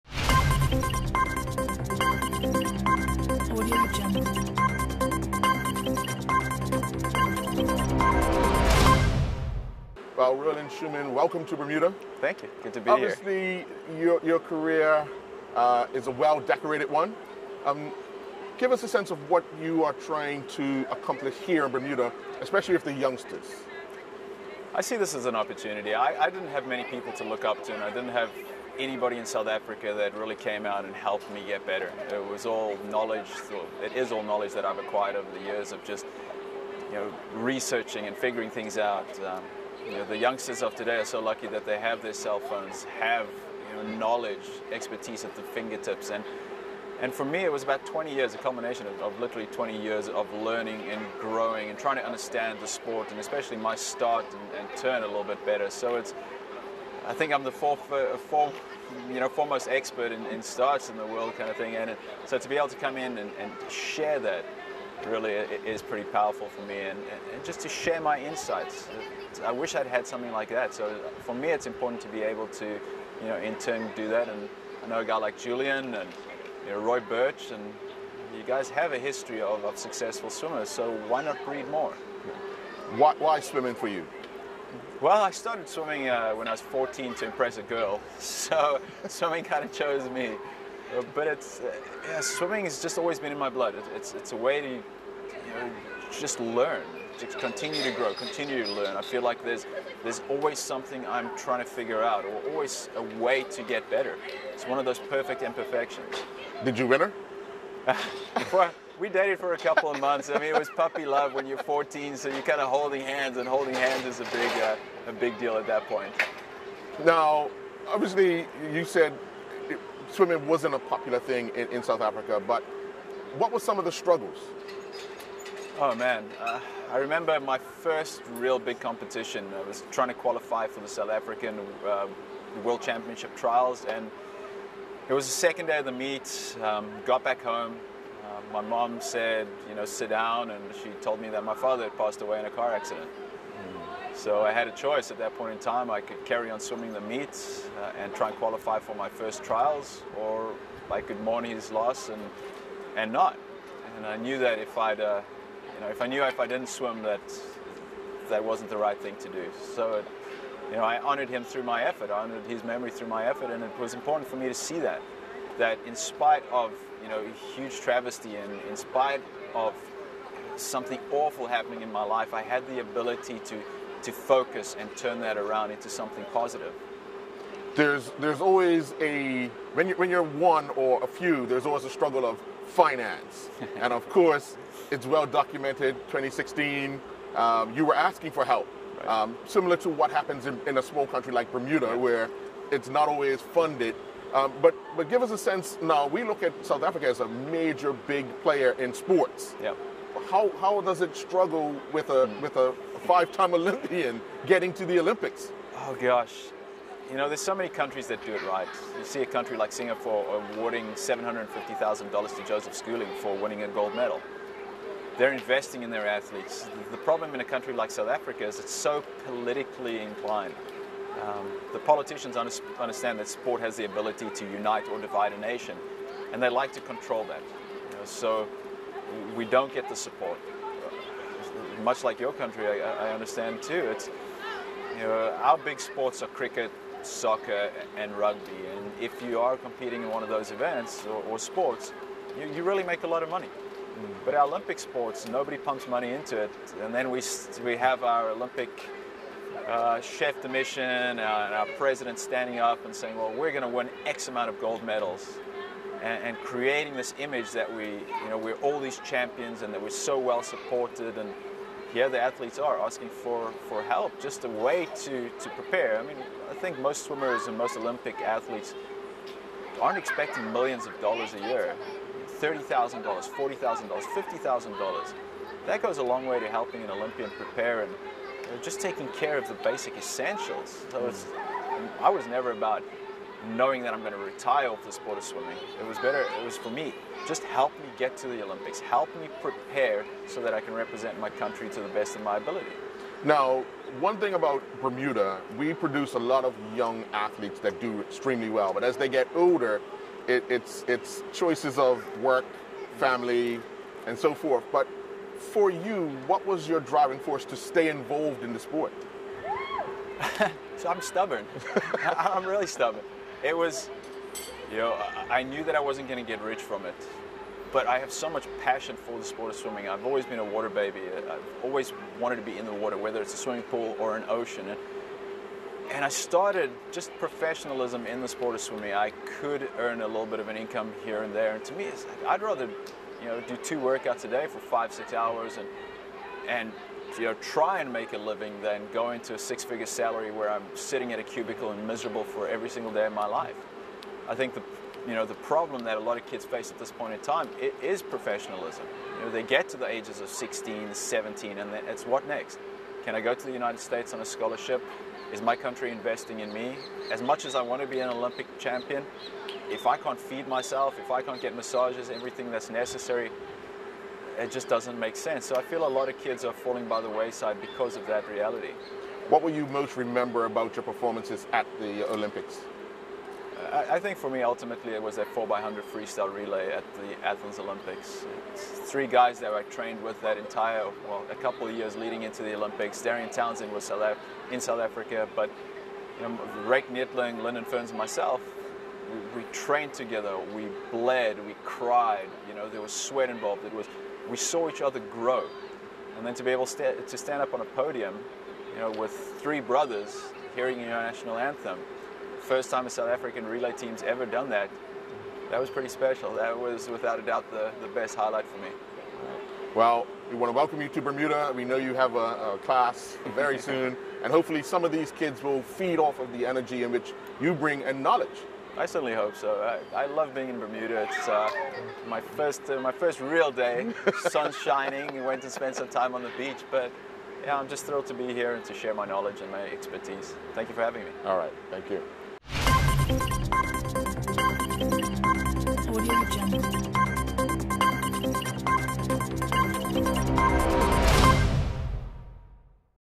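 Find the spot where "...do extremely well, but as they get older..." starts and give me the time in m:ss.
4:57.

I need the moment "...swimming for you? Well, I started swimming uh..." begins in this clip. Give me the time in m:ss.
1:23.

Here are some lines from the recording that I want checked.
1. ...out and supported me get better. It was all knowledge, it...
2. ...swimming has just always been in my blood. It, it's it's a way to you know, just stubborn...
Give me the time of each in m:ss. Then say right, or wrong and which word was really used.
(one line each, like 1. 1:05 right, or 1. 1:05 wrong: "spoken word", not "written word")
1. 0:30 wrong: "helped", not "supported"
2. 1:32 wrong: "learn", not "stubborn".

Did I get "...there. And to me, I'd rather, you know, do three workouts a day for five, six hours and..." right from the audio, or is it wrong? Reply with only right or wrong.
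wrong.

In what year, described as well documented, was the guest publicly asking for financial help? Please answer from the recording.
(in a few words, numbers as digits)
2016.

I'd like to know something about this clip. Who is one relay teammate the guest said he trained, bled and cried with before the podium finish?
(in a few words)
Lyndon Ferns.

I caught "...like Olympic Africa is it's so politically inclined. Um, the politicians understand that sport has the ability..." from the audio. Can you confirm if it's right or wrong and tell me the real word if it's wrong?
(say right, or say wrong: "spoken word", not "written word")
wrong: "South", not "Olympic".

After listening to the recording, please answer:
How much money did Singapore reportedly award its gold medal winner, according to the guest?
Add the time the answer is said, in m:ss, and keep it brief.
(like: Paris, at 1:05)
$750,000, at 3:30.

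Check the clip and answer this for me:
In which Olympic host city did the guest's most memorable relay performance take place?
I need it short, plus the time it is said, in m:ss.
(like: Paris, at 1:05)
Athens, at 6:17.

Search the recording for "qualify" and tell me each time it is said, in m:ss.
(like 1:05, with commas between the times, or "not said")
2:10, 2:28.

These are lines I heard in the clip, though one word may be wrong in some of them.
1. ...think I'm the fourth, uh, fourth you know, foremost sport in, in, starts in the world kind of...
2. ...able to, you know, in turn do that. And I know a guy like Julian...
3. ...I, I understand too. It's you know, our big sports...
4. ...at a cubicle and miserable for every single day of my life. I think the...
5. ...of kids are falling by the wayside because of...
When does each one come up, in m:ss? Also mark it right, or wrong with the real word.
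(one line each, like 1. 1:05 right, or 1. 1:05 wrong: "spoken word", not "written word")
1. 0:57 wrong: "expert", not "sport"
2. 1:12 right
3. 3:52 right
4. 5:41 right
5. 6:06 right.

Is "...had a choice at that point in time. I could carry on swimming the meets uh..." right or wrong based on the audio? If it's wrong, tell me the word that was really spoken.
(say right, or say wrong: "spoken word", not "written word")
right.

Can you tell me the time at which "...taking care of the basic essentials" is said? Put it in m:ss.
4:38.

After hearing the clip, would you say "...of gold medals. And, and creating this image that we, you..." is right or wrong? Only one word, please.
right.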